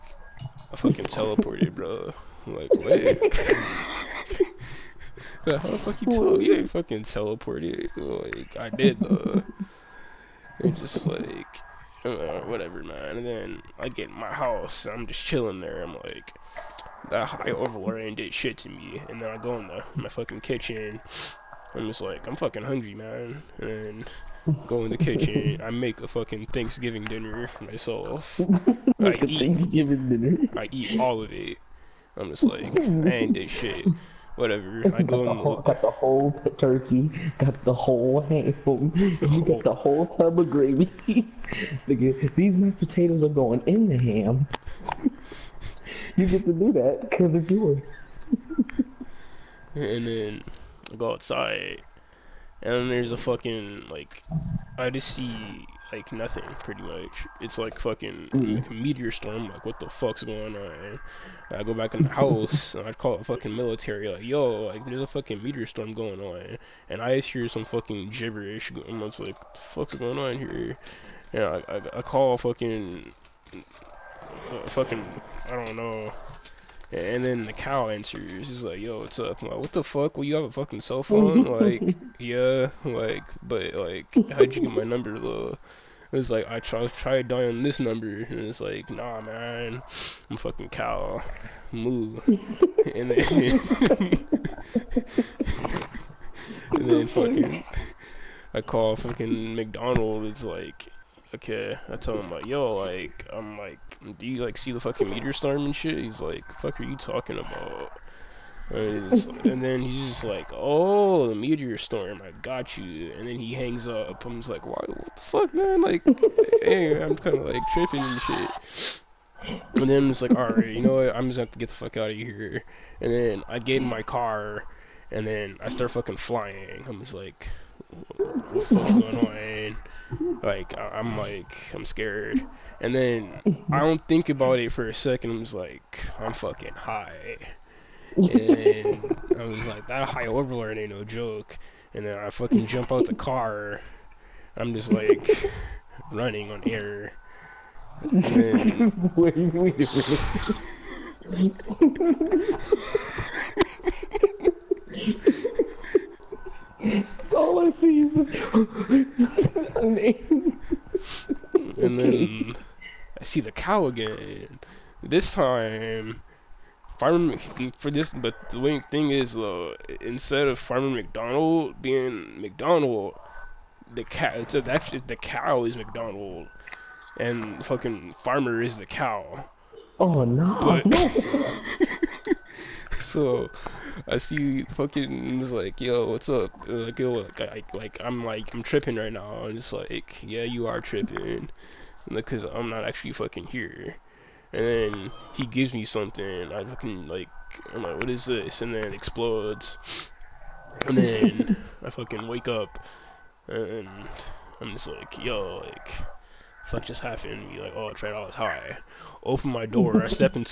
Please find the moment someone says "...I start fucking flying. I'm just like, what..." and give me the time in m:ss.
2:05.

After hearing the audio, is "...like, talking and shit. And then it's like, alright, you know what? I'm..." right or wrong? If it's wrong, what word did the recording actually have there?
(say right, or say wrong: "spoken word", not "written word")
wrong: "tripping", not "talking".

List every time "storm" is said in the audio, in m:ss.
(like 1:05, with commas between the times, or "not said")
0:59, 1:05, 1:45, 1:51.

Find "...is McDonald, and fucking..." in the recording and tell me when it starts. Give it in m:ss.
2:55.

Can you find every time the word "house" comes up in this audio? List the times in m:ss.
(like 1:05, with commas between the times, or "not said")
0:14, 1:02.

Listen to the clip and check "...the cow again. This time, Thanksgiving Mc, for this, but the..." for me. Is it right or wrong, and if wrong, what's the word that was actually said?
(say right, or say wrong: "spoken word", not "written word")
wrong: "Farmer", not "Thanksgiving".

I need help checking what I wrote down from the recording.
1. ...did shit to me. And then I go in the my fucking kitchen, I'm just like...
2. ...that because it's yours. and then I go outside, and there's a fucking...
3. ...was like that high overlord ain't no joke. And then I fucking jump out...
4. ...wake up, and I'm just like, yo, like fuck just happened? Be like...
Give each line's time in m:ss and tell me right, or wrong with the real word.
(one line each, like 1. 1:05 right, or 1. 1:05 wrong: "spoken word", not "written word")
1. 0:18 right
2. 0:46 right
3. 2:19 right
4. 3:22 right.